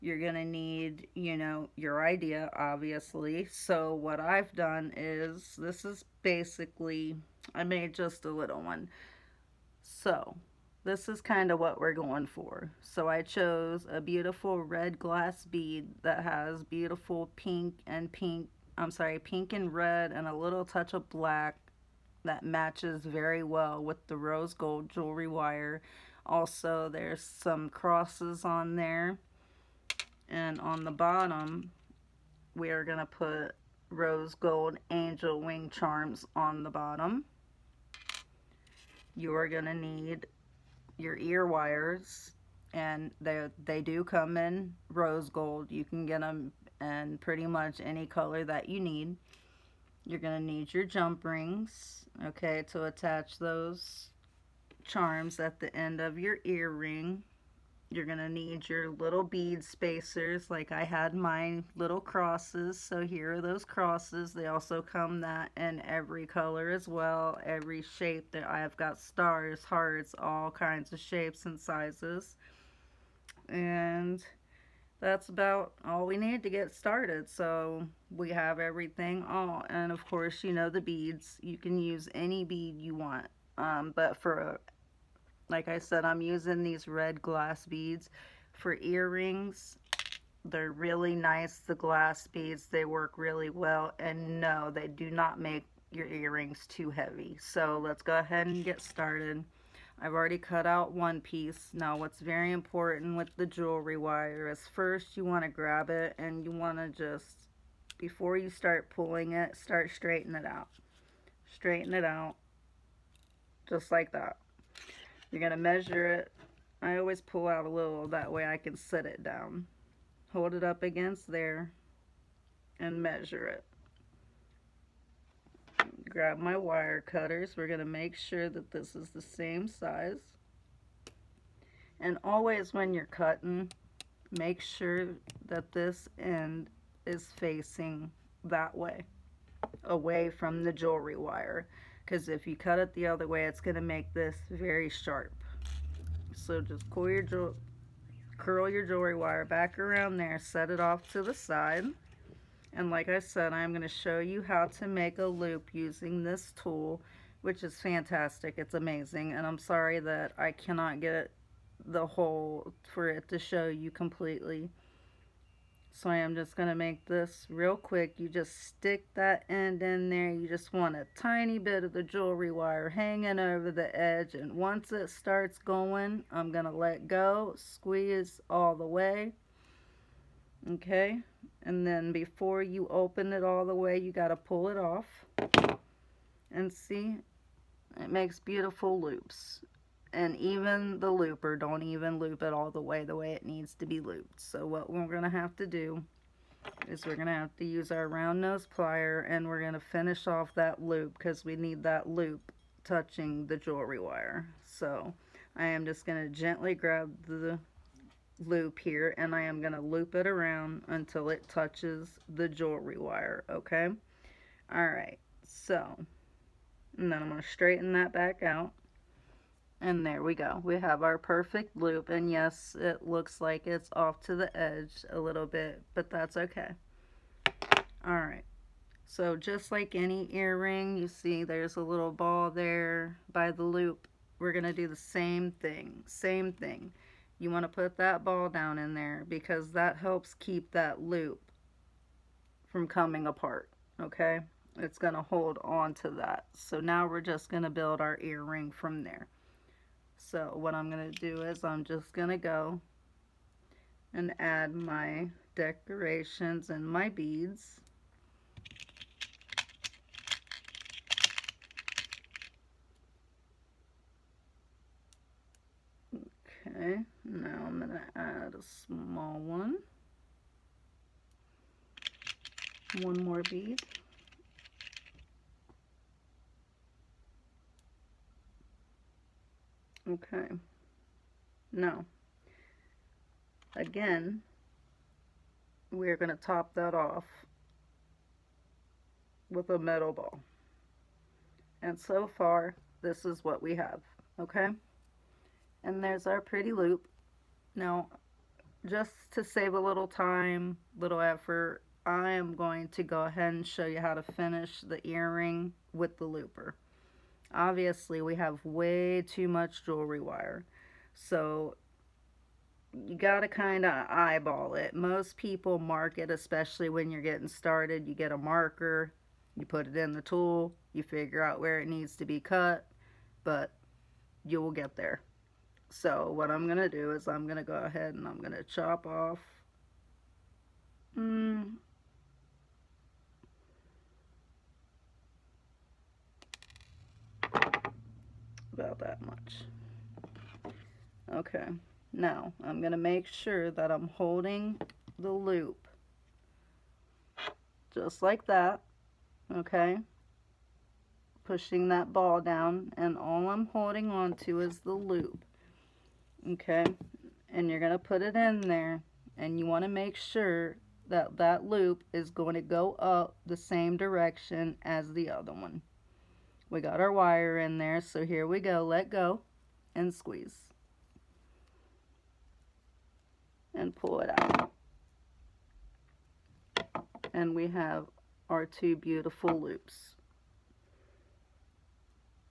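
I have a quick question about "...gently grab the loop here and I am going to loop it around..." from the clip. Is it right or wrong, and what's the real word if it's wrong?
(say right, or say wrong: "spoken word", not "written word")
right.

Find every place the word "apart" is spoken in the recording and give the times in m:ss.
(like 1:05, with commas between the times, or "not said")
4:03.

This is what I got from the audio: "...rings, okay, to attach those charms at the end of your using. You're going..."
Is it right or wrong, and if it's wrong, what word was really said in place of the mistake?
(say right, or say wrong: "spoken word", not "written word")
wrong: "earring", not "using".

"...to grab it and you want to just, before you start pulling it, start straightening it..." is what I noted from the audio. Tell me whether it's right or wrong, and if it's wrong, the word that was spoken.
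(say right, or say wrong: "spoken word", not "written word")
right.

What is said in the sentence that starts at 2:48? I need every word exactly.
You just stick that end in there.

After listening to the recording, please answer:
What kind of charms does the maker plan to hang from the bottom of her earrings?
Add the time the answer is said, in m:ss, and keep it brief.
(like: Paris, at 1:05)
Angel wing charms, at 0:34.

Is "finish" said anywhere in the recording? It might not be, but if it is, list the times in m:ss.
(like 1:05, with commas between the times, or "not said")
3:19, 5:04.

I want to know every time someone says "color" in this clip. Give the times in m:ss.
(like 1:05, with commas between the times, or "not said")
0:48, 1:06.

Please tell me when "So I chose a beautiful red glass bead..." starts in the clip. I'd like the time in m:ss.
0:12.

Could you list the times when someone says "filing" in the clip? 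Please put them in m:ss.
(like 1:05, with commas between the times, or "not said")
not said.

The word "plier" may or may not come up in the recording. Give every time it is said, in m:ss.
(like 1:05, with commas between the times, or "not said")
3:18.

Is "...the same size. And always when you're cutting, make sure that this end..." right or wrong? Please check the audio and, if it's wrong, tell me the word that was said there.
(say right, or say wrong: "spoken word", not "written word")
right.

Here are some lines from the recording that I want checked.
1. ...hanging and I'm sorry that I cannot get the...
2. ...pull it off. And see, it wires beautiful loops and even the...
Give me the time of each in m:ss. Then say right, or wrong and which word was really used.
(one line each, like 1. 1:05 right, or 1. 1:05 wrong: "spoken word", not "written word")
1. 2:38 wrong: "amazing", not "hanging"
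2. 3:04 wrong: "makes", not "wires".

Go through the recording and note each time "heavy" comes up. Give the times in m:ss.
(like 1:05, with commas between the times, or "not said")
1:36.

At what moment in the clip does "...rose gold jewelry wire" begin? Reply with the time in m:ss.
0:24.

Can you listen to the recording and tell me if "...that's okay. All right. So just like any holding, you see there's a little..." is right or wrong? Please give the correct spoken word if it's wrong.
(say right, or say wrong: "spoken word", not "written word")
wrong: "earring", not "holding".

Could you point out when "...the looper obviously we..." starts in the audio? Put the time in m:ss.
5:06.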